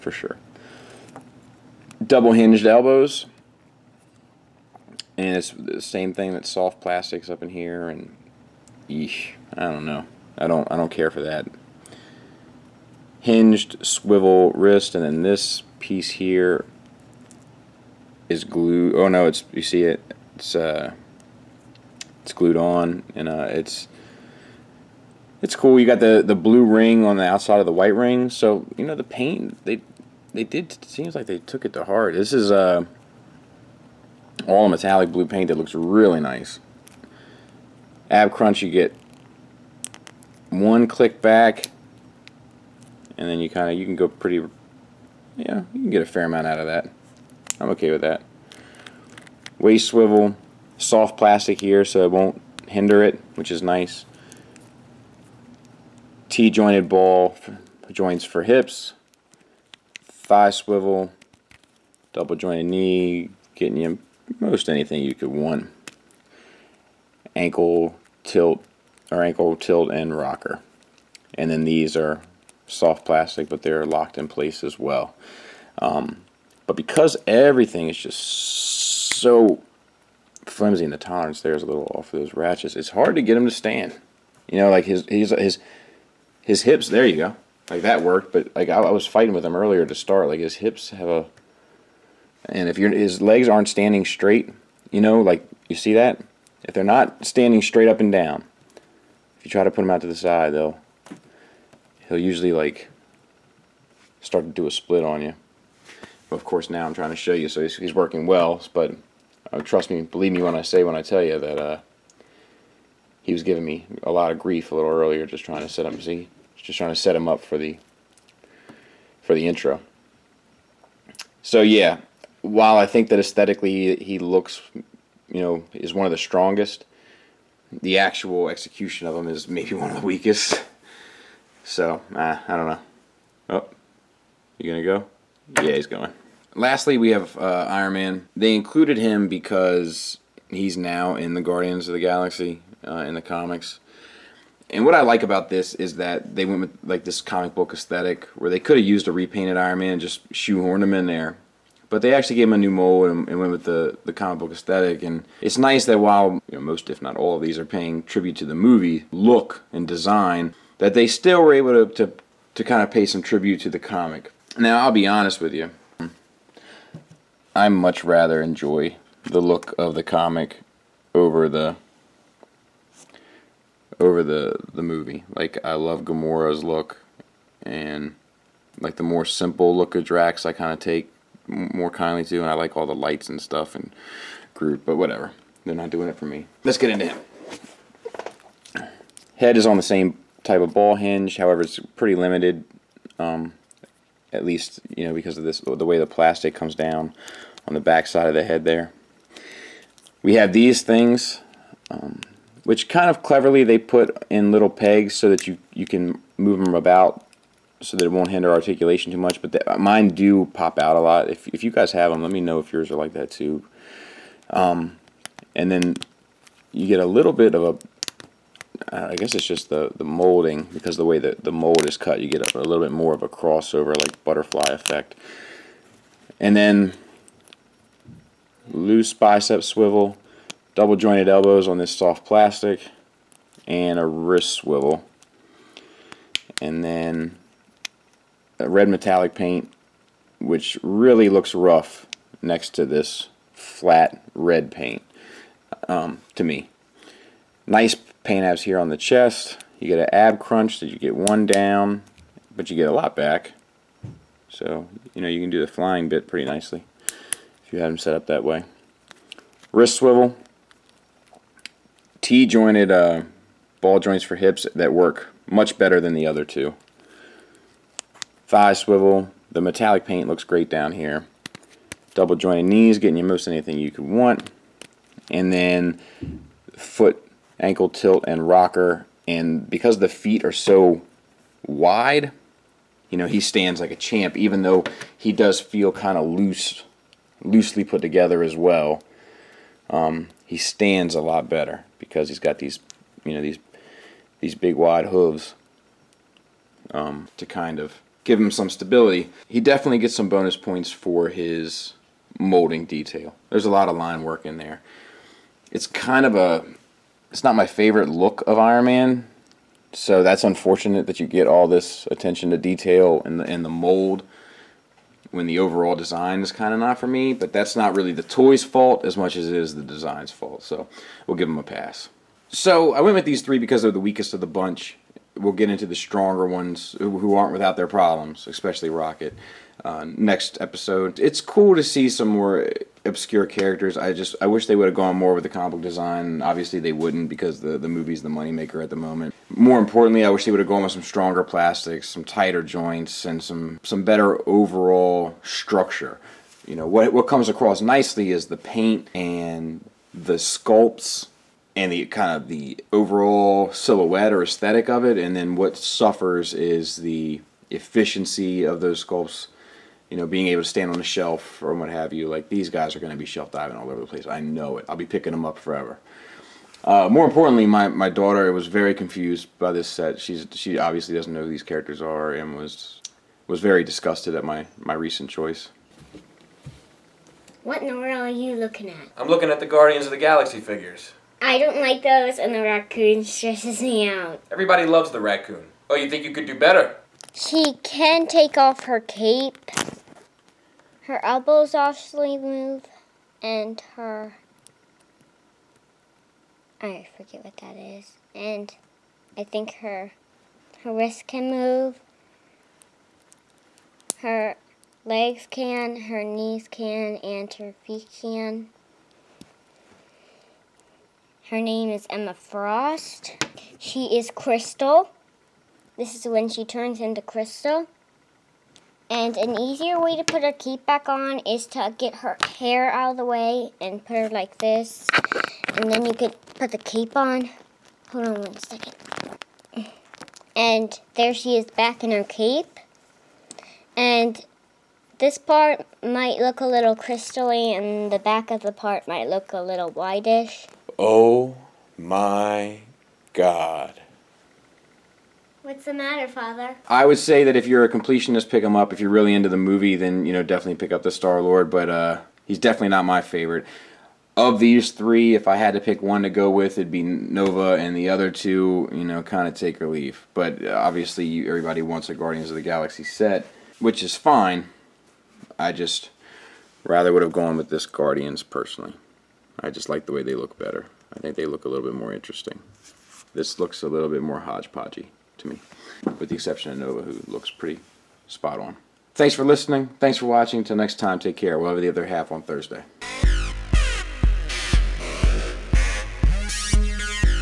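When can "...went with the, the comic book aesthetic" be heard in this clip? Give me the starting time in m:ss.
2:33.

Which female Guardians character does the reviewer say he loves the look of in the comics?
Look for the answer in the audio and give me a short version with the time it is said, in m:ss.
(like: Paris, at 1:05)
Gamora, at 2:56.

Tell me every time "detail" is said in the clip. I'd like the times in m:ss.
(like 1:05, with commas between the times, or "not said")
5:02, 5:12.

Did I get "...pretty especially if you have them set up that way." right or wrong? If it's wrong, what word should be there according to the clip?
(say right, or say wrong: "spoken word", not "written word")
wrong: "nicely", not "especially".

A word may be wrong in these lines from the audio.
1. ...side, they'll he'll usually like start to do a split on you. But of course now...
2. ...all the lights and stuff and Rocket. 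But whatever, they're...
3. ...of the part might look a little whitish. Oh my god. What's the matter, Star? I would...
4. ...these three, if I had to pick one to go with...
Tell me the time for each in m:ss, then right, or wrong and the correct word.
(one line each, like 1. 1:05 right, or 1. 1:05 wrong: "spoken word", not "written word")
1. 1:40 right
2. 3:02 wrong: "Groot", not "Rocket"
3. 7:18 wrong: "Father", not "Star"
4. 7:34 right.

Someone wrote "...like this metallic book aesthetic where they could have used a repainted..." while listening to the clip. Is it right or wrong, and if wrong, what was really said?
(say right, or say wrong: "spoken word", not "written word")
wrong: "comic", not "metallic".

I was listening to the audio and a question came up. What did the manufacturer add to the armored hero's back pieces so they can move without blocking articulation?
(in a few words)
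Little pegs.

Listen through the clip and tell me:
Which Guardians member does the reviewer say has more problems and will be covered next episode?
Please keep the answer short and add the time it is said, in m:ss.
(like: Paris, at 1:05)
Rocket, at 5:28.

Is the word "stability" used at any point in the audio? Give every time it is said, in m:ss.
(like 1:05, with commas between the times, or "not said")
4:58.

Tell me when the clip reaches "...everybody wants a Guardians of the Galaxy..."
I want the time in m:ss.
7:41.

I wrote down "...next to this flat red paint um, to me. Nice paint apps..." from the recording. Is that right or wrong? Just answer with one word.
right.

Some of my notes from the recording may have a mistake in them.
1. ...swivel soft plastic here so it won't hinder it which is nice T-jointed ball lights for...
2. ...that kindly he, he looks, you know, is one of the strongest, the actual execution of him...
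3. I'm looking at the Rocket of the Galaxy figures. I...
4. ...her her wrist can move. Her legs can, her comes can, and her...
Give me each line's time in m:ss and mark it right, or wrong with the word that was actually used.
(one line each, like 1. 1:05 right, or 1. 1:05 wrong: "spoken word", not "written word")
1. 0:49 wrong: "joints", not "lights"
2. 2:03 wrong: "aesthetically", not "kindly"
3. 6:19 wrong: "Guardians", not "Rocket"
4. 6:39 wrong: "knees", not "comes".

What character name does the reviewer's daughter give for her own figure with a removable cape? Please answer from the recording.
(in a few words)
Emma Frost.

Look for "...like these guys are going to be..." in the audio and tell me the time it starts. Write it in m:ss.
6:02.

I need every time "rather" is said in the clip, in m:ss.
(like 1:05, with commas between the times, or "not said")
2:48, 7:46.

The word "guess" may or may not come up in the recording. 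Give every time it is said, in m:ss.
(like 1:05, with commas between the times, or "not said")
3:39.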